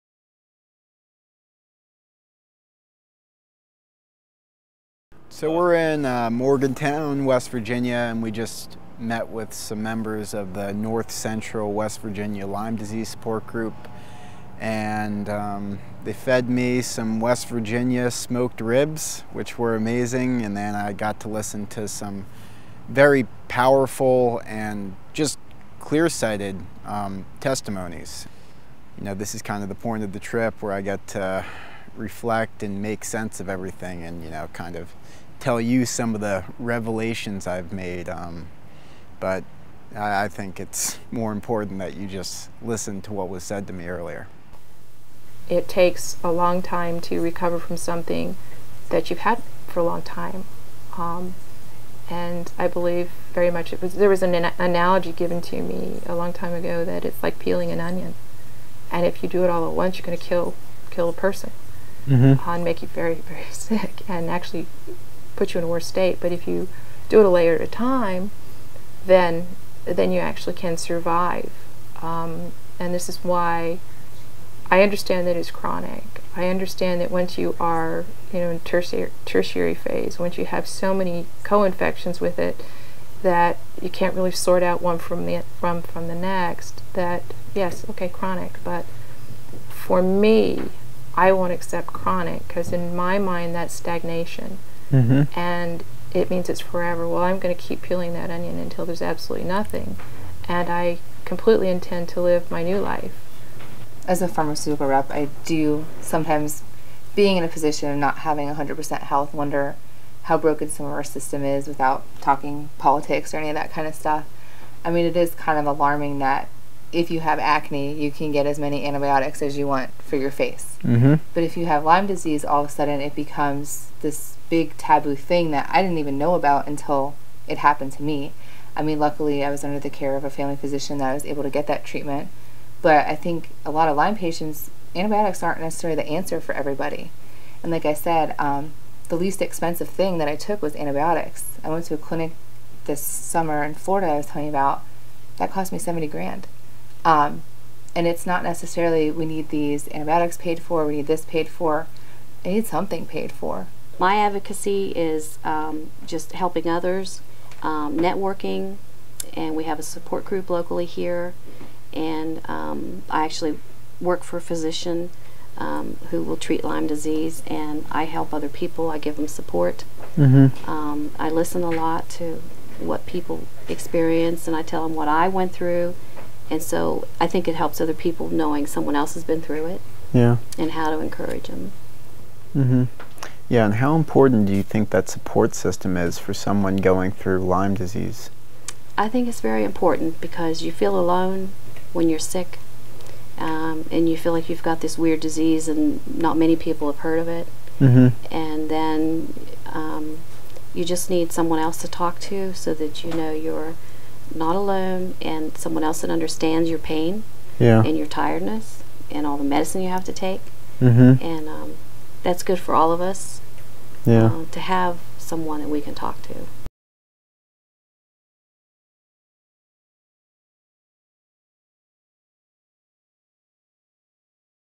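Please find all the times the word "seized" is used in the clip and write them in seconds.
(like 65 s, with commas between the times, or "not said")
not said.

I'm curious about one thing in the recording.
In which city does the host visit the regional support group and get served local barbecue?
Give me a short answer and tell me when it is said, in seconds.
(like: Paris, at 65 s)
Morgantown, at 6 s.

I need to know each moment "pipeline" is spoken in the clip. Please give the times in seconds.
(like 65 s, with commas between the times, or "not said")
not said.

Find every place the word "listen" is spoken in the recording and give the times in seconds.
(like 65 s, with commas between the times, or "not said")
21 s, 42 s, 171 s.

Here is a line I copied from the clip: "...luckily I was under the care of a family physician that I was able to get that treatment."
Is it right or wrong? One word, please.
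right.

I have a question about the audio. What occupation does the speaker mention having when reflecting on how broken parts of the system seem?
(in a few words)
Pharmaceutical rep.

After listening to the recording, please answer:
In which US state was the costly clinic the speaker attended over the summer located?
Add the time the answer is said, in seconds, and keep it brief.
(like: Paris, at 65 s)
Florida, at 143 s.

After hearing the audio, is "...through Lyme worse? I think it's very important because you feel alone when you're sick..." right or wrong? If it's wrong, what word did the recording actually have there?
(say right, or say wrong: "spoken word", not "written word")
wrong: "disease", not "worse".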